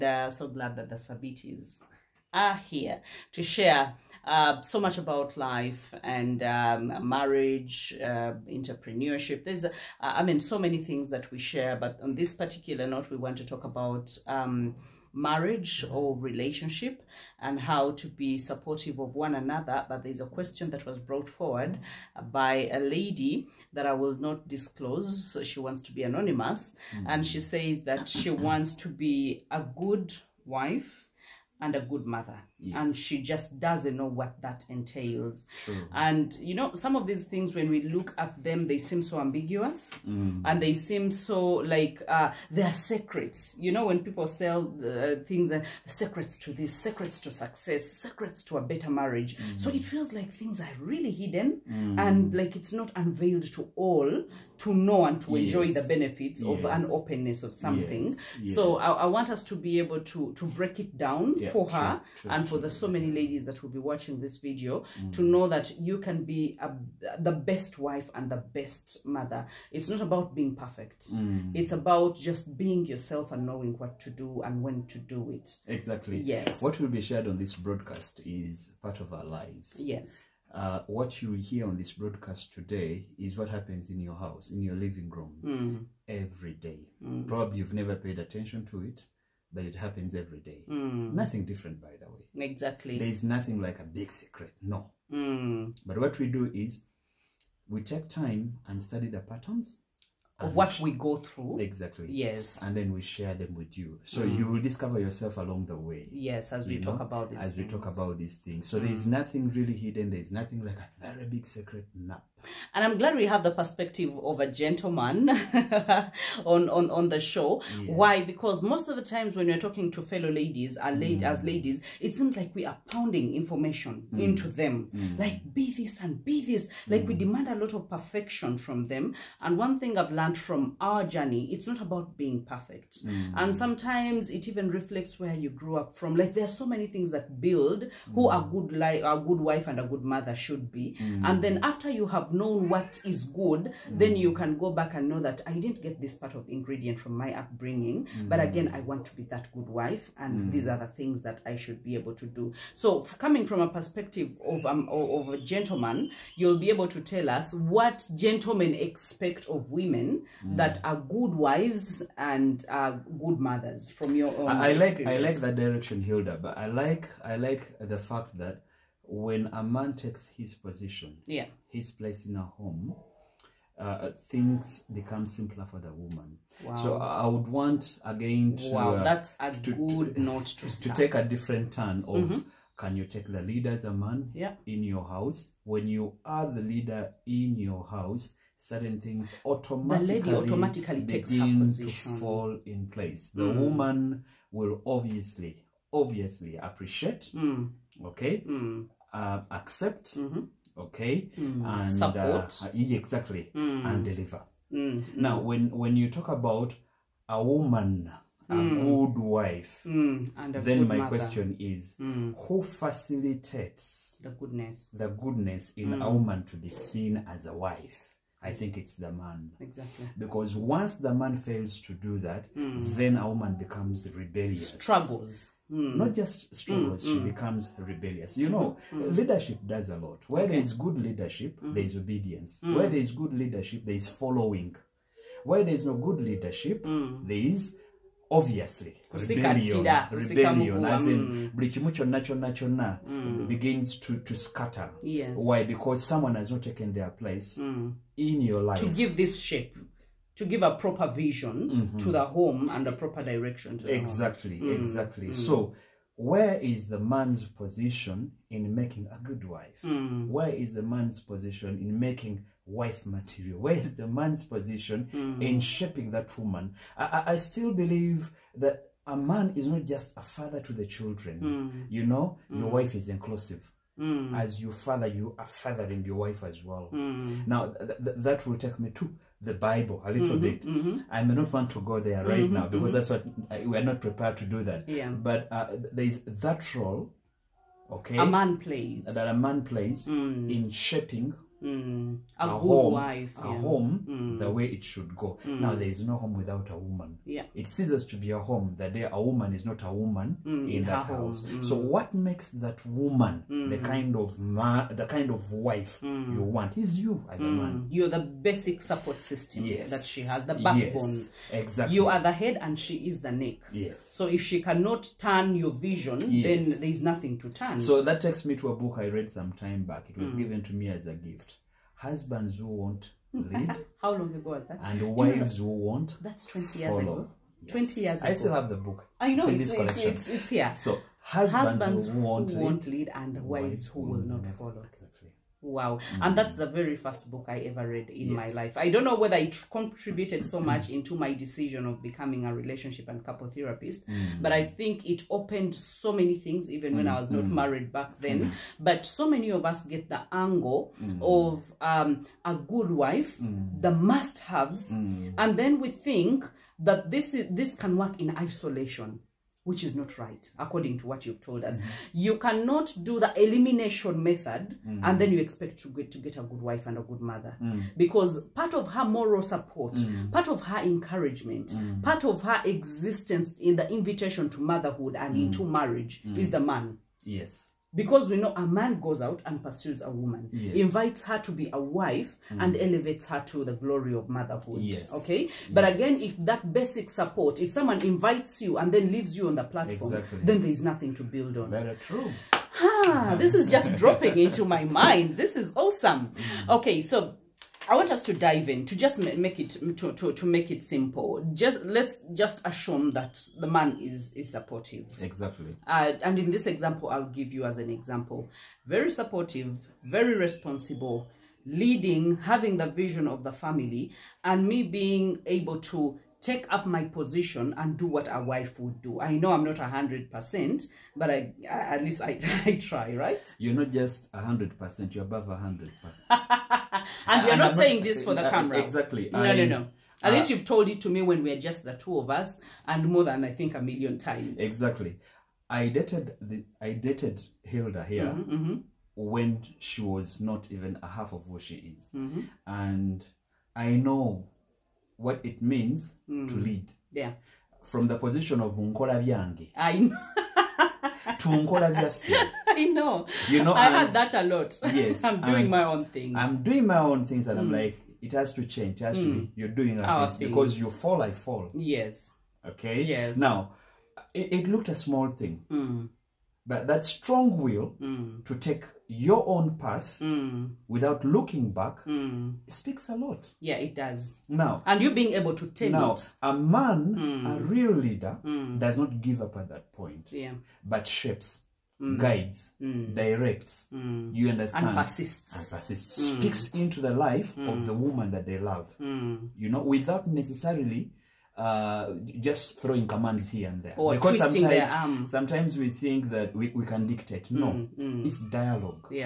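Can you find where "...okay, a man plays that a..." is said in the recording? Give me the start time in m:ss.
4:47.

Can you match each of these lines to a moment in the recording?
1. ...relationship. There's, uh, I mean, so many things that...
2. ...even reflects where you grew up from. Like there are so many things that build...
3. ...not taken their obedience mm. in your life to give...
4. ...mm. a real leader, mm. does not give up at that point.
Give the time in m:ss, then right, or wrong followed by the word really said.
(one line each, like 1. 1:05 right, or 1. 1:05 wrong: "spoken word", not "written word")
1. 0:08 wrong: "entrepreneurship", not "relationship"
2. 2:14 right
3. 4:06 wrong: "place", not "obedience"
4. 7:57 right.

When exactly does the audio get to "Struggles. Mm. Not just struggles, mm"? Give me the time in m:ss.
3:44.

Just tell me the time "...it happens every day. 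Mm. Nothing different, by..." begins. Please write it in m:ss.
1:29.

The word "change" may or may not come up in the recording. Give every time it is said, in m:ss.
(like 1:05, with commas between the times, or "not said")
7:38.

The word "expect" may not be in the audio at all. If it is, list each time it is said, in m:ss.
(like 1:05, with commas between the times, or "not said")
2:38, 6:05.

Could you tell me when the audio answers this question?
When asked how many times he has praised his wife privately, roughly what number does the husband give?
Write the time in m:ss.
7:13.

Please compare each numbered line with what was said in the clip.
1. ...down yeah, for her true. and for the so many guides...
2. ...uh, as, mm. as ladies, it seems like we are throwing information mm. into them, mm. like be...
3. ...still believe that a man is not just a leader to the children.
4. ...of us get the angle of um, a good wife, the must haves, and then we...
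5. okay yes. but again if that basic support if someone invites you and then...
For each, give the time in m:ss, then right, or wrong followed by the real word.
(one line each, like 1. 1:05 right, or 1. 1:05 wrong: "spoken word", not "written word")
1. 1:00 wrong: "ladies", not "guides"
2. 2:00 wrong: "pounding", not "throwing"
3. 4:27 wrong: "father", not "leader"
4. 5:49 right
5. 6:25 right.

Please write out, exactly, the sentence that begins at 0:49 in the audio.
so it feels like things are really hidden mm.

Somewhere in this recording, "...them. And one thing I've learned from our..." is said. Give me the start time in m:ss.
2:08.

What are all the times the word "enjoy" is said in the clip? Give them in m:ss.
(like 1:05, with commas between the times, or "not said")
0:55.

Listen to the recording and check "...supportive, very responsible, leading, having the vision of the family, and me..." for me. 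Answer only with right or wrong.
right.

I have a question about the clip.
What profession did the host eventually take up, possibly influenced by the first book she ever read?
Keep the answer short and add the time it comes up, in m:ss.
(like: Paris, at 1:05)
Relationship and couple therapist, at 5:42.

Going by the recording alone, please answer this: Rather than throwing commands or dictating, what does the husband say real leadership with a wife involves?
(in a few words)
Dialogue.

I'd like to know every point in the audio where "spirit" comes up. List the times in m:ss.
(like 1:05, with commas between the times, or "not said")
not said.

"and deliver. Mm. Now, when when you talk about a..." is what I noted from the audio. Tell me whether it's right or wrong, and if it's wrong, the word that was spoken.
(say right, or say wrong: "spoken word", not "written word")
right.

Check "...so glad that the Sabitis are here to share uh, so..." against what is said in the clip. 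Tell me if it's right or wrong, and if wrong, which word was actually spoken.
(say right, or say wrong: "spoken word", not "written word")
right.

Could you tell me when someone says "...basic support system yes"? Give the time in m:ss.
5:08.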